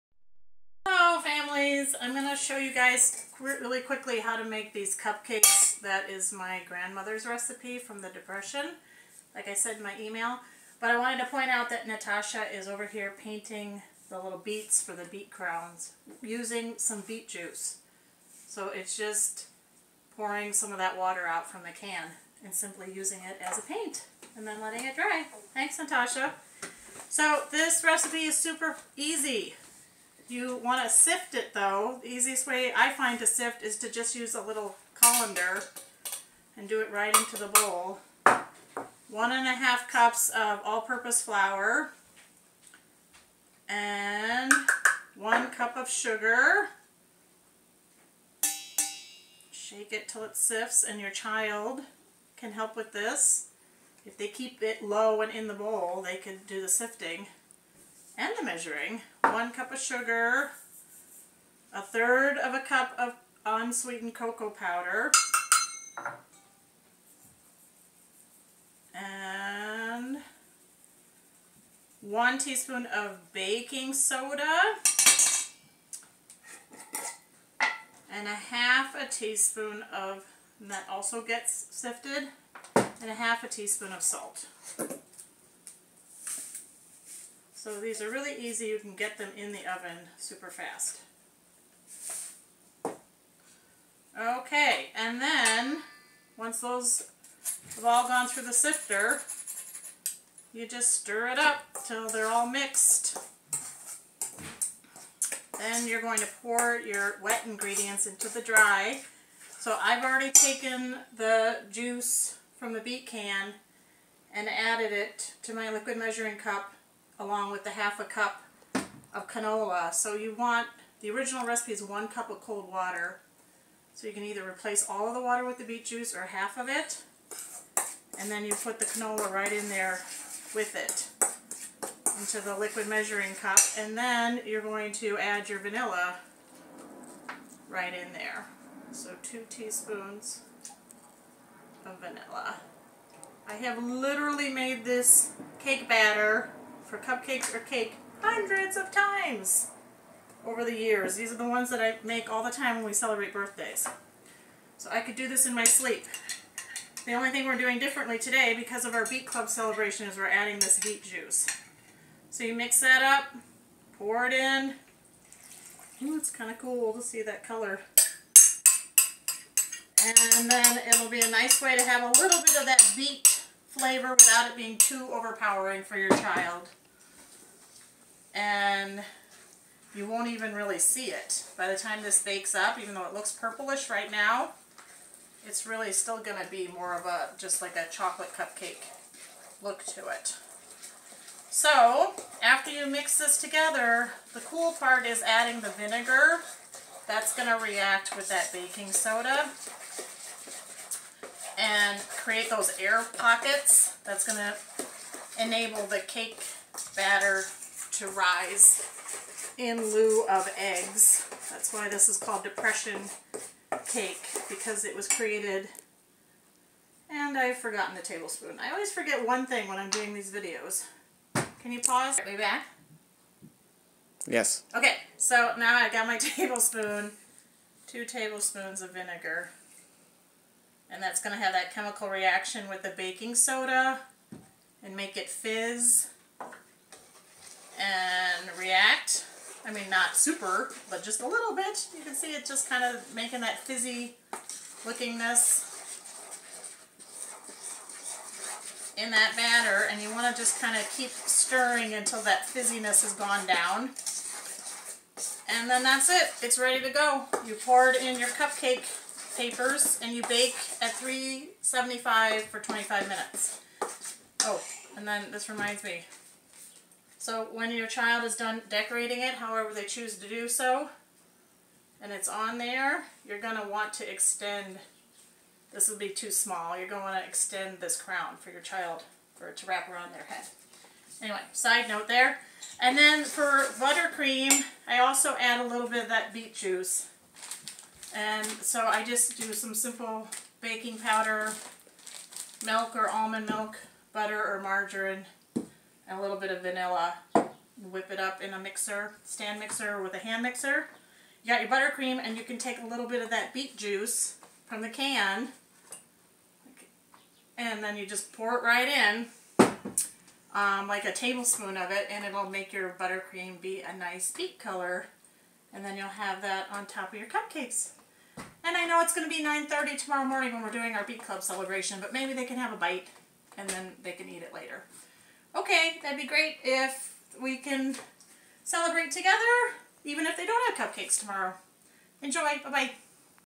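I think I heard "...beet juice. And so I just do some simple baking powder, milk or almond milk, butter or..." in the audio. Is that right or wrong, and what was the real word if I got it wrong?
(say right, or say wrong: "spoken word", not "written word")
right.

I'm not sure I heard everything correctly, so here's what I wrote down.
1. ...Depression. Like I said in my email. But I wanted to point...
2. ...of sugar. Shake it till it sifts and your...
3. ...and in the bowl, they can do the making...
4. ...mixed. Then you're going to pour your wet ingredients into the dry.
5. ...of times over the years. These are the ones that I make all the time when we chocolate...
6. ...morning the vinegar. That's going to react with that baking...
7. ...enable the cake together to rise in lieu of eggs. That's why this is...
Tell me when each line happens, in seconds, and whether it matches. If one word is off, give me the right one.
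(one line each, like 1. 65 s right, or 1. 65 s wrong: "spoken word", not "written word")
1. 8 s right
2. 45 s right
3. 55 s wrong: "sifting", not "making"
4. 102 s right
5. 148 s wrong: "celebrate", not "chocolate"
6. 195 s wrong: "adding", not "morning"
7. 205 s wrong: "batter", not "together".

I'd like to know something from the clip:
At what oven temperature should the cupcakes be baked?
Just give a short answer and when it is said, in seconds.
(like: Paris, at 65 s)
375, at 260 s.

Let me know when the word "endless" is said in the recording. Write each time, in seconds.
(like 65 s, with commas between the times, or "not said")
not said.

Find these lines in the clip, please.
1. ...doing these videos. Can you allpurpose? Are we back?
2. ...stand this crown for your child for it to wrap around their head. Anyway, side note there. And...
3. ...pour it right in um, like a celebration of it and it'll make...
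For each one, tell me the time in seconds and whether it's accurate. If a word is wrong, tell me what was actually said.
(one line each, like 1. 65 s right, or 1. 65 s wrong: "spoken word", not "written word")
1. 219 s wrong: "pause", not "allpurpose"
2. 277 s wrong: "extend", not "stand"
3. 308 s wrong: "tablespoon", not "celebration".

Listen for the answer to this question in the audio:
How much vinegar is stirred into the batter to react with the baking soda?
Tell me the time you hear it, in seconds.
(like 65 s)
227 s.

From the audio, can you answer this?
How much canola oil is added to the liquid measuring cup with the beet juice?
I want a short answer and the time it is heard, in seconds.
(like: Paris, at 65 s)
half a cup, at 117 s.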